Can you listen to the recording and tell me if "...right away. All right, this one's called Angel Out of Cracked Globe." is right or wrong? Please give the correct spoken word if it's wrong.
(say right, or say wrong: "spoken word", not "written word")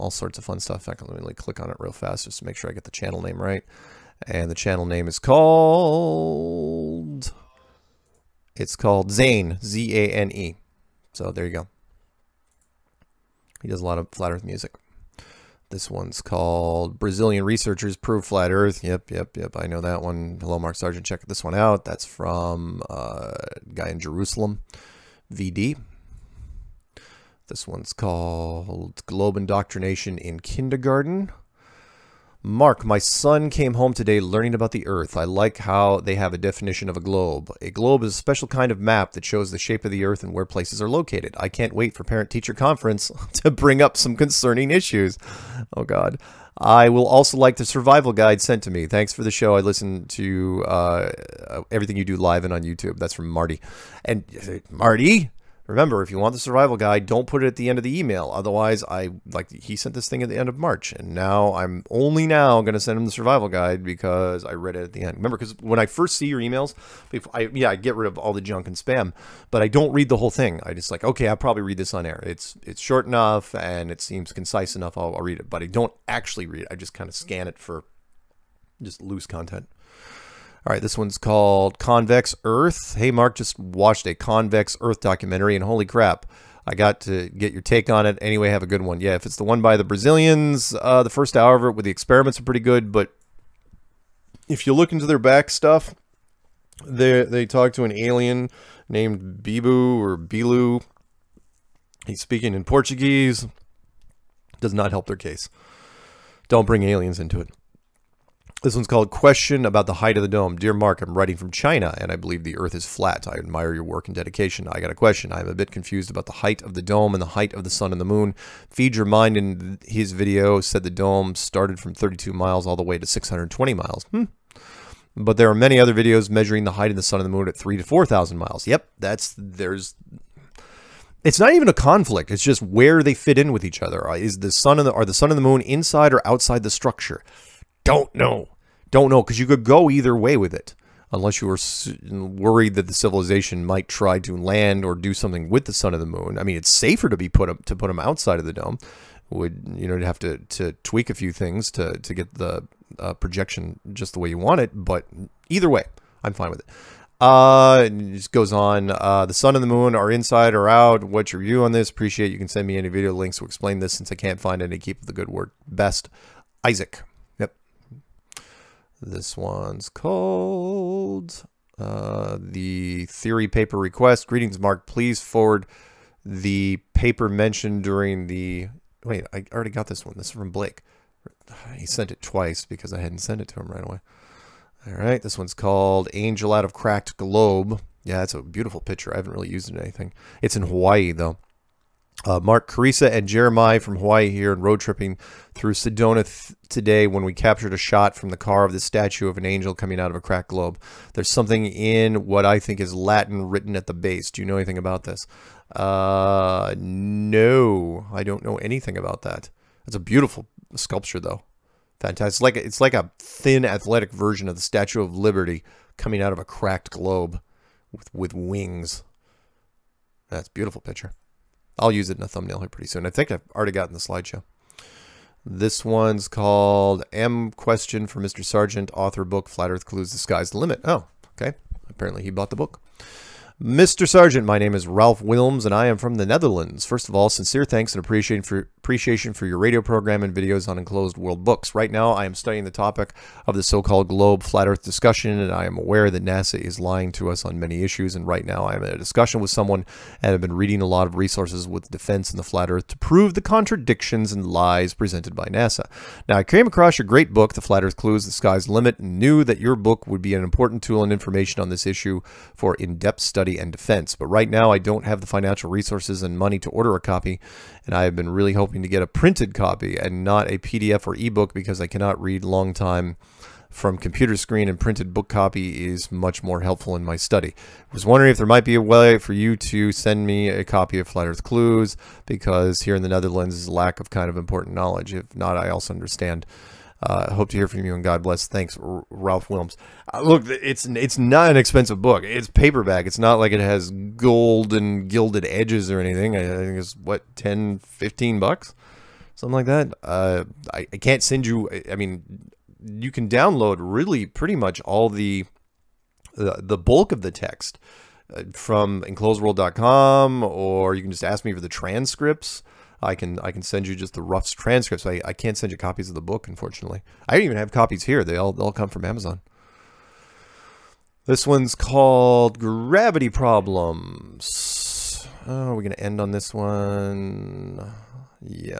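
right.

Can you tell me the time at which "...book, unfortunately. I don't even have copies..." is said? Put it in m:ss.
5:16.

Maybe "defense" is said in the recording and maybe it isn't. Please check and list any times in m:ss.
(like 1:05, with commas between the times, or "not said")
4:11, 4:23.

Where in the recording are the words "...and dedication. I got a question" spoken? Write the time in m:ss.
1:54.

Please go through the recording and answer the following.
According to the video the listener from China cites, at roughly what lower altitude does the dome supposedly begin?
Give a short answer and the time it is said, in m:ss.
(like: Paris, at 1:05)
32 miles, at 2:01.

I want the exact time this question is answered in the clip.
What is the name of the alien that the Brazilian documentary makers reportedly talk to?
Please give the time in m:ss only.
1:39.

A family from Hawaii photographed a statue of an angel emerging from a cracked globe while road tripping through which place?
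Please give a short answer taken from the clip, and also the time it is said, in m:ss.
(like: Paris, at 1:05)
Sedona, at 3:15.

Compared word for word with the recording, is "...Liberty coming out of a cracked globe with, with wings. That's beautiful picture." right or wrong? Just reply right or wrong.
right.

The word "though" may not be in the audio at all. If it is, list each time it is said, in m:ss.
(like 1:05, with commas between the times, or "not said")
3:11, 3:31.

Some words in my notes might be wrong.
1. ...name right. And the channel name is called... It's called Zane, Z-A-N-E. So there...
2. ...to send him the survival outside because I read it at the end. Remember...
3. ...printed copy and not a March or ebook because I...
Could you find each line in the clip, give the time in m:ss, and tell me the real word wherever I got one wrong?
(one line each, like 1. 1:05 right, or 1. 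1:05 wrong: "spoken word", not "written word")
1. 0:03 right
2. 1:02 wrong: "guide", not "outside"
3. 4:29 wrong: "PDF", not "March".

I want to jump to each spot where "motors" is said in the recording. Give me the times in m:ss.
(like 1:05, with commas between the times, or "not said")
not said.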